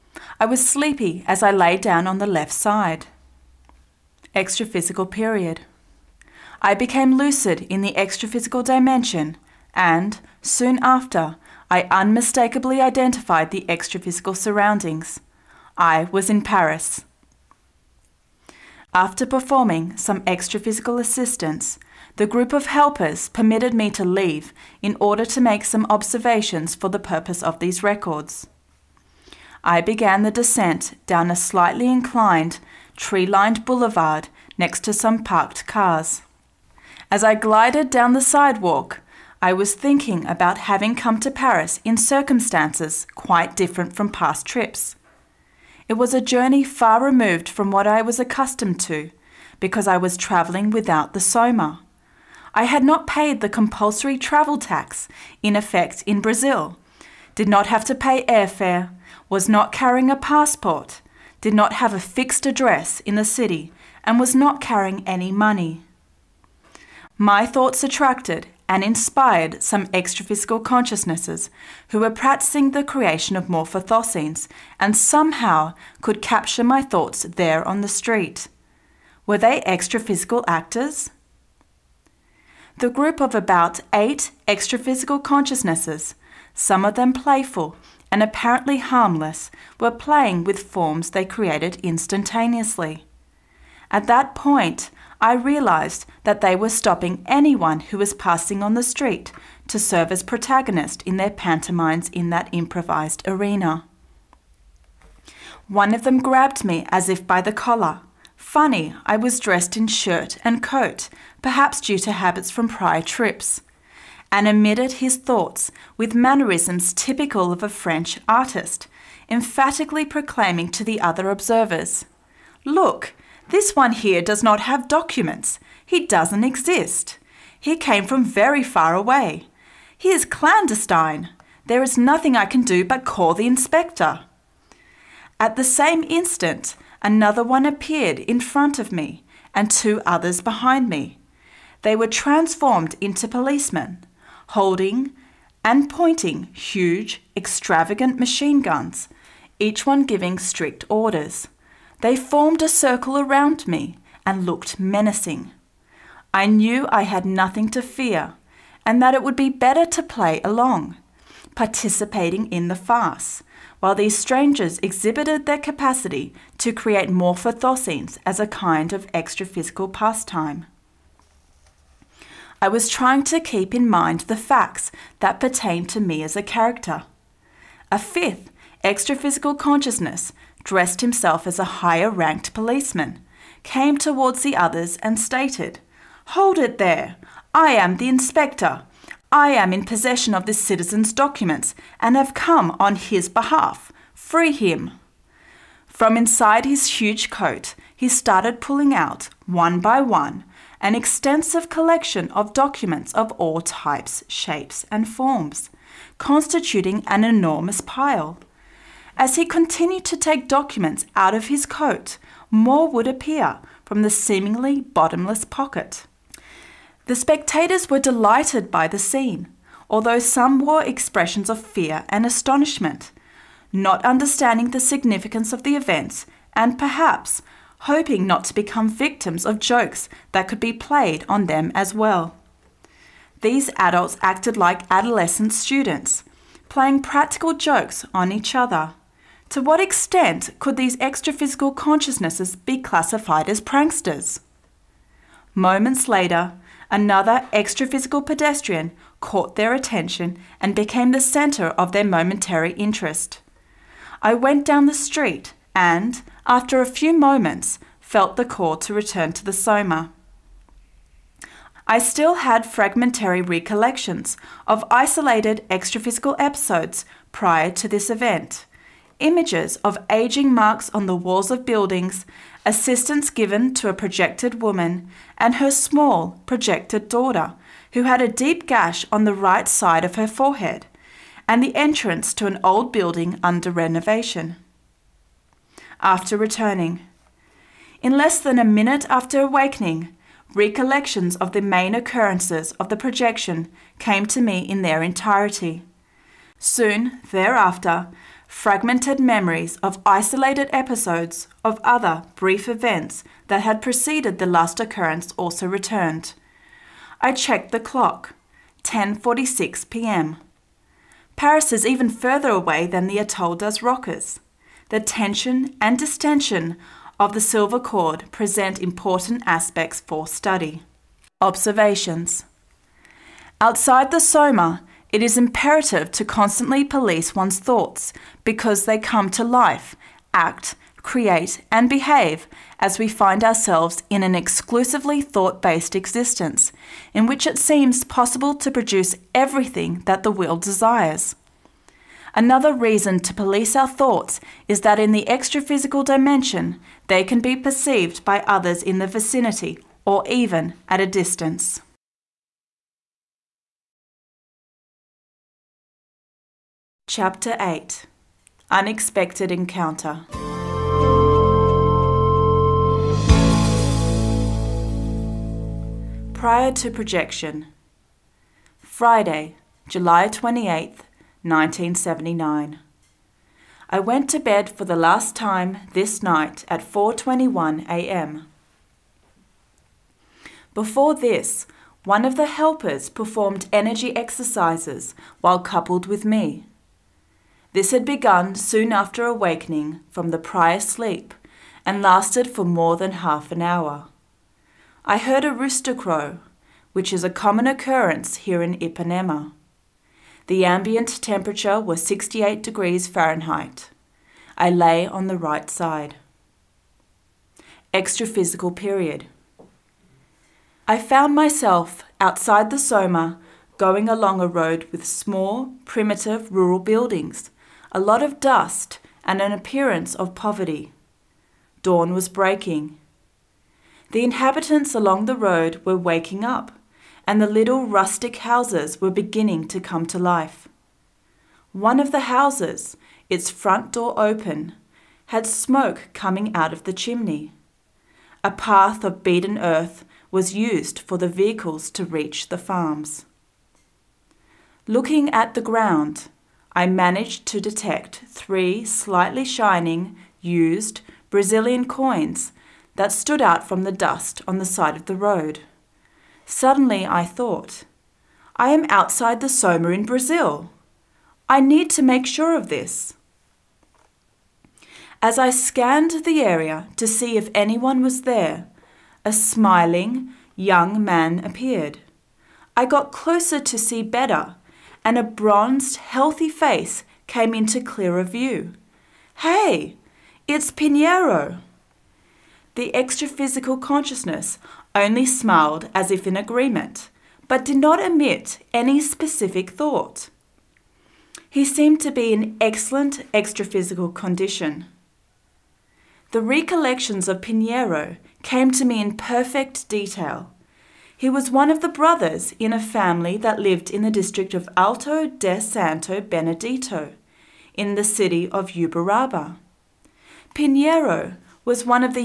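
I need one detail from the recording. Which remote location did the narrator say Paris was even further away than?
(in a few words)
Atoll das Rocas.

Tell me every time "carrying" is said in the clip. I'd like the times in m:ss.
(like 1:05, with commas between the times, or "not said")
0:59, 1:04.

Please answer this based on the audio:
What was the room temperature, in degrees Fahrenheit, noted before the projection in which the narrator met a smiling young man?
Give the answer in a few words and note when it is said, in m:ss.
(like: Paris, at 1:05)
68, at 6:42.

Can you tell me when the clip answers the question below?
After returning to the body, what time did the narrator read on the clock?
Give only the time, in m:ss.
5:08.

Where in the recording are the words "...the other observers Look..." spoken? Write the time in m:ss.
2:00.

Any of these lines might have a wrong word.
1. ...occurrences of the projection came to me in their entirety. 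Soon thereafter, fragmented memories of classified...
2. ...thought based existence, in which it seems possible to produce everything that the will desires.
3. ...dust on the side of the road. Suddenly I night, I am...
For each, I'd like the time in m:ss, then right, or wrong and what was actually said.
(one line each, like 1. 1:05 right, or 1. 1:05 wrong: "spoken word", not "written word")
1. 4:51 wrong: "isolated", not "classified"
2. 5:35 right
3. 7:33 wrong: "thought", not "night".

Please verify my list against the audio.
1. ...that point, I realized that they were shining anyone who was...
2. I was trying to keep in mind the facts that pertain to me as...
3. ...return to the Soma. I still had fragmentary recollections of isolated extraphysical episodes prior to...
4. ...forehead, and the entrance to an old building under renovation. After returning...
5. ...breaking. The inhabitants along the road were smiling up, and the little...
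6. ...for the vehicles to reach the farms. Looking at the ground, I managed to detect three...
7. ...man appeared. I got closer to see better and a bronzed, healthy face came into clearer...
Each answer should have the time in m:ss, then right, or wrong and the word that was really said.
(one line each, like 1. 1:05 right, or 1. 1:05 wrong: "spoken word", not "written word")
1. 1:34 wrong: "stopping", not "shining"
2. 2:52 right
3. 4:18 right
4. 4:40 right
5. 7:02 wrong: "waking", not "smiling"
6. 7:20 right
7. 7:51 right.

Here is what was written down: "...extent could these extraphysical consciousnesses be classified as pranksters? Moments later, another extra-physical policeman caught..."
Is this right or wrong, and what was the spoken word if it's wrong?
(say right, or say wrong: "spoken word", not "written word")
wrong: "pedestrian", not "policeman".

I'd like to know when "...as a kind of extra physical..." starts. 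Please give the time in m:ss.
2:48.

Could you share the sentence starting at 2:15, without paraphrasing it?
At the same instant, Another one appeared in front of me, and two others behind me.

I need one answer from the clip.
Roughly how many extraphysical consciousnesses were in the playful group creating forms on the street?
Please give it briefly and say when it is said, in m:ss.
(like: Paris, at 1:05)
about eight, at 1:23.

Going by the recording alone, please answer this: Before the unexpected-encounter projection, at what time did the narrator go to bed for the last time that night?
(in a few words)
4:21 a.m.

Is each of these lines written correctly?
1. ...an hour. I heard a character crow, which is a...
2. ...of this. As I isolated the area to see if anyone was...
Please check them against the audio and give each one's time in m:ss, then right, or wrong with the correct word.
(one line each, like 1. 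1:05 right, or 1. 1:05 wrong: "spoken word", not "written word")
1. 6:33 wrong: "rooster", not "character"
2. 7:42 wrong: "scanned", not "isolated".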